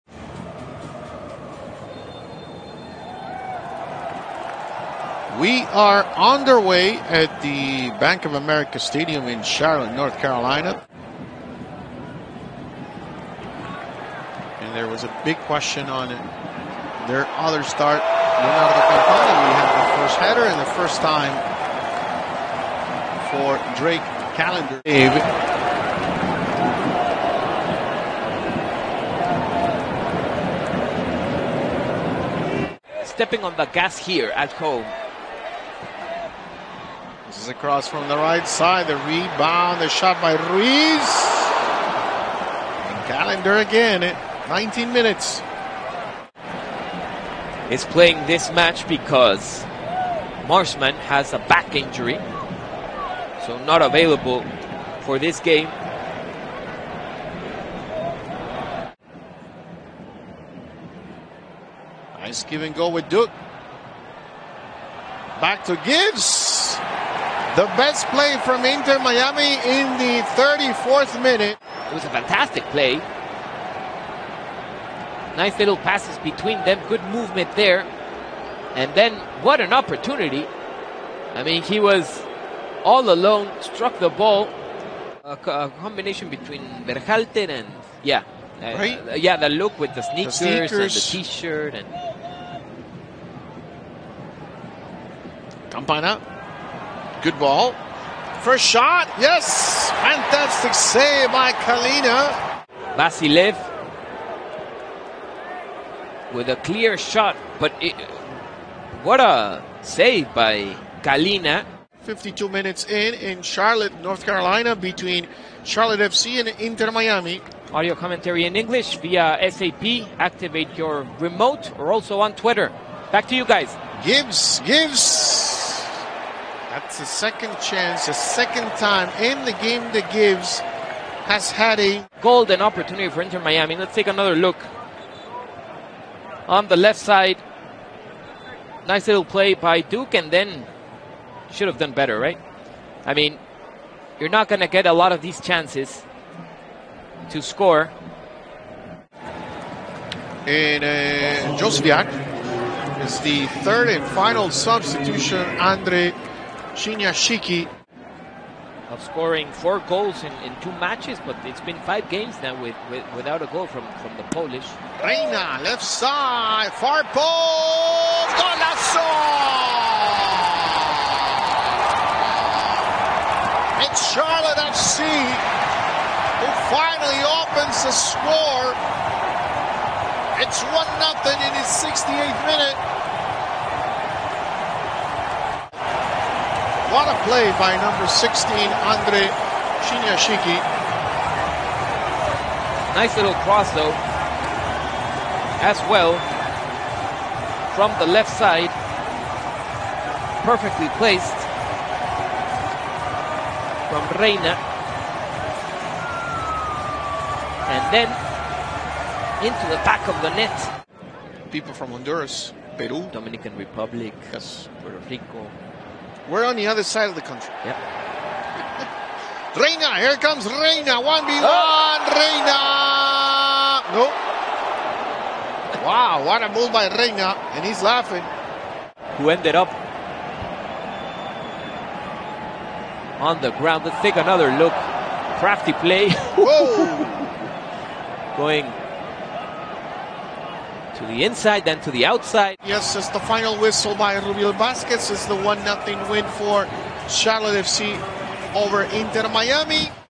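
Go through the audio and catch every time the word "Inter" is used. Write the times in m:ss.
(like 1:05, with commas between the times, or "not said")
1:08, 1:56, 2:13, 4:08.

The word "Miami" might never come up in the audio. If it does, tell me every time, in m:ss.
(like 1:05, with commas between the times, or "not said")
1:08, 1:56, 2:13, 4:09.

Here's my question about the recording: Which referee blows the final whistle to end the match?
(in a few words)
Rubiel Vazquez.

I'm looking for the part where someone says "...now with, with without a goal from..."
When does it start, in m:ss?
2:42.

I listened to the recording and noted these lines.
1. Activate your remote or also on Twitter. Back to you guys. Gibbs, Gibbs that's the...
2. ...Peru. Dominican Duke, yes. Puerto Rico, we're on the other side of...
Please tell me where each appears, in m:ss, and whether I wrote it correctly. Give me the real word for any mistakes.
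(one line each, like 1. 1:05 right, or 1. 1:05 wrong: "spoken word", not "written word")
1. 2:00 right
2. 3:32 wrong: "Republic", not "Duke".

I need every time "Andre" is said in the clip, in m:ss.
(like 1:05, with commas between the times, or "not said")
2:35, 3:08.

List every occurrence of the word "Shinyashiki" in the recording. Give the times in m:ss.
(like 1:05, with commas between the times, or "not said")
2:36, 3:09.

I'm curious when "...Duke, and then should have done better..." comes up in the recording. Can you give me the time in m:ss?
2:19.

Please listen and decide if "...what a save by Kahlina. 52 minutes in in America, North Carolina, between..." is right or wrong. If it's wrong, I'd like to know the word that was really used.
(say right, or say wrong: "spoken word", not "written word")
wrong: "Charlotte", not "America".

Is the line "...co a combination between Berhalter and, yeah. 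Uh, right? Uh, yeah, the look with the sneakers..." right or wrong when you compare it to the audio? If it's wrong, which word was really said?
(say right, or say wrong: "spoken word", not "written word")
right.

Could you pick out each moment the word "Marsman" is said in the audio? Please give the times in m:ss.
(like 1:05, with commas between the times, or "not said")
0:50.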